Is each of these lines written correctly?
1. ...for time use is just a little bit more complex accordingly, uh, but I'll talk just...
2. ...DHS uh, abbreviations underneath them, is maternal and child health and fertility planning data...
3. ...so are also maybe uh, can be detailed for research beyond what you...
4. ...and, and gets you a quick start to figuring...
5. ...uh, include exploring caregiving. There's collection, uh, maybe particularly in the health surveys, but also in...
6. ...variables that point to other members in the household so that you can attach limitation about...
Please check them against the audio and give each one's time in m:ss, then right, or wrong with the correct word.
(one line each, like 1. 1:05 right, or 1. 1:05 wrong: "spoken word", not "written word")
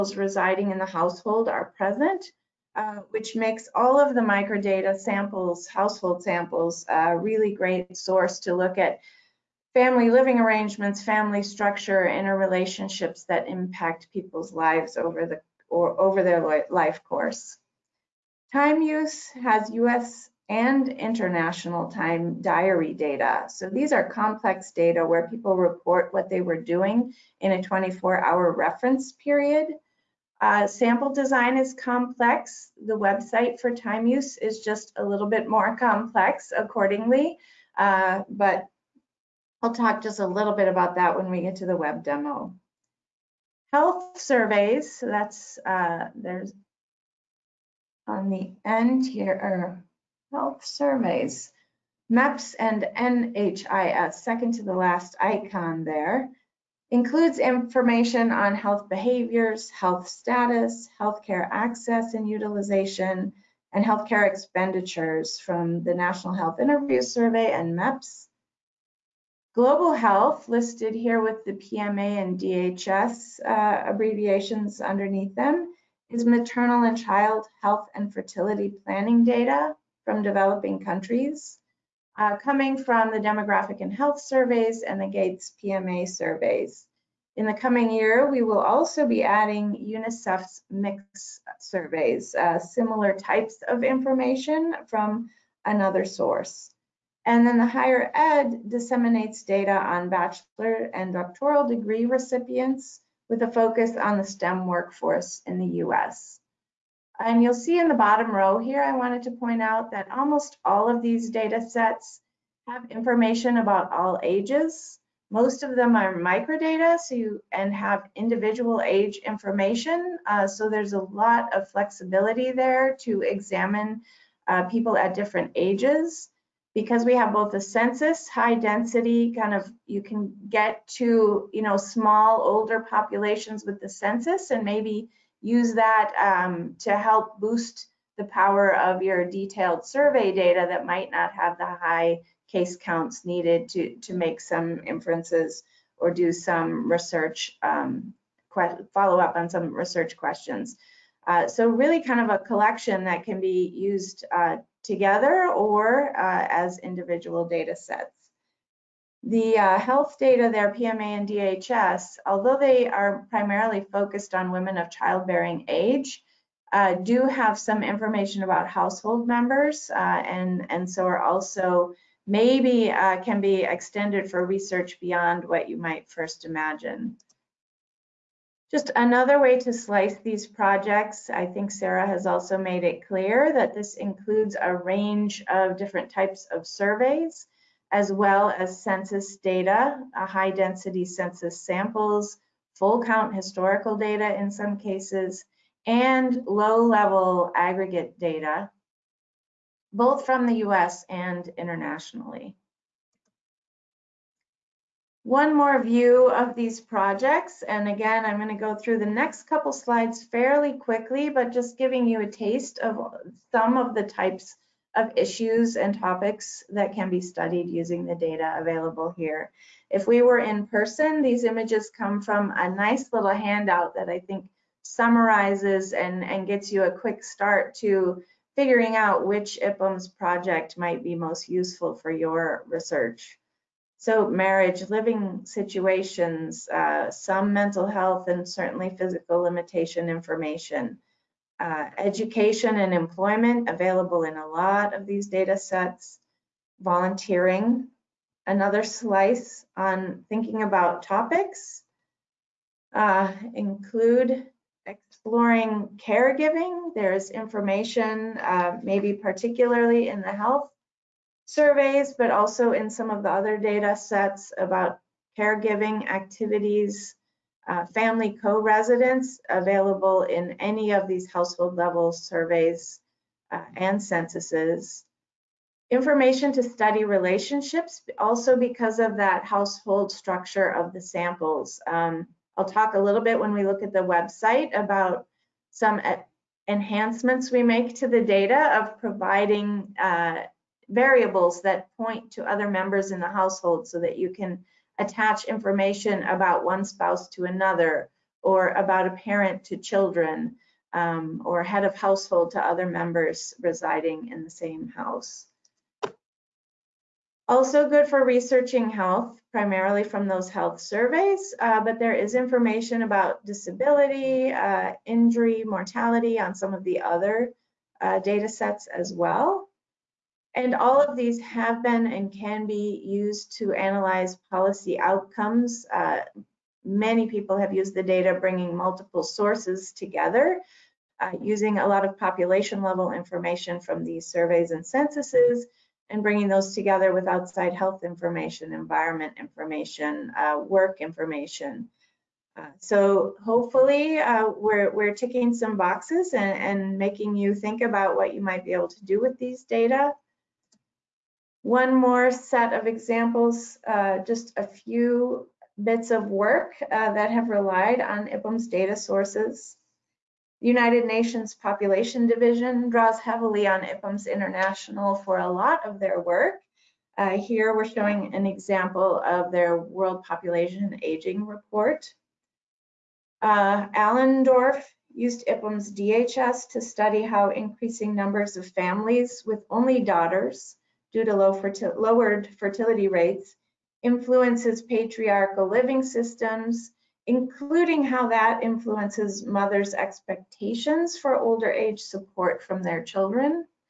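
1. 0:33 right
2. 1:12 right
3. 2:50 wrong: "extended", not "detailed"
4. 3:45 right
5. 4:12 wrong: "information", not "collection"
6. 4:50 wrong: "information", not "limitation".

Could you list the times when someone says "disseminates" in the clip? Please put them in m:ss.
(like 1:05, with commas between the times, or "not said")
1:38.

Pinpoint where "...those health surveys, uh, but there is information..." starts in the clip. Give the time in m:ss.
5:10.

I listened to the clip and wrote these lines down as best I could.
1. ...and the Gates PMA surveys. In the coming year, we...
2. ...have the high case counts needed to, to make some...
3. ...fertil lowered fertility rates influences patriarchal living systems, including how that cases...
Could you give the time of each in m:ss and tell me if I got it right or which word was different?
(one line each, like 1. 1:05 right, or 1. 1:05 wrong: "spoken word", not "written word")
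1. 1:24 right
2. 2:21 right
3. 6:21 wrong: "influences", not "cases".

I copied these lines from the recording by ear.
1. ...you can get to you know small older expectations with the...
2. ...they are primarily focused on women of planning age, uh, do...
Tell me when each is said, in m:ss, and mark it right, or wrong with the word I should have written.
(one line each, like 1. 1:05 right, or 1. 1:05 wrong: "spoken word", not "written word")
1. 2:09 wrong: "populations", not "expectations"
2. 2:42 wrong: "childbearing", not "planning".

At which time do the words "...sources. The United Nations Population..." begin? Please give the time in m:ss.
5:58.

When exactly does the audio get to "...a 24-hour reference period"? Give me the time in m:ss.
0:27.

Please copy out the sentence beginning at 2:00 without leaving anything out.
Uh, so there's a lot of flexibility there to examine uh, people at different ages.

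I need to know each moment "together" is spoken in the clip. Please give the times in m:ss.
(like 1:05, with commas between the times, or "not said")
2:34, 5:29, 5:36.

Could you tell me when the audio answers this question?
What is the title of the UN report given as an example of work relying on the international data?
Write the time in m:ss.
6:09.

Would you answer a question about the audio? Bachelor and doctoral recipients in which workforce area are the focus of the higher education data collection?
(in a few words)
STEM.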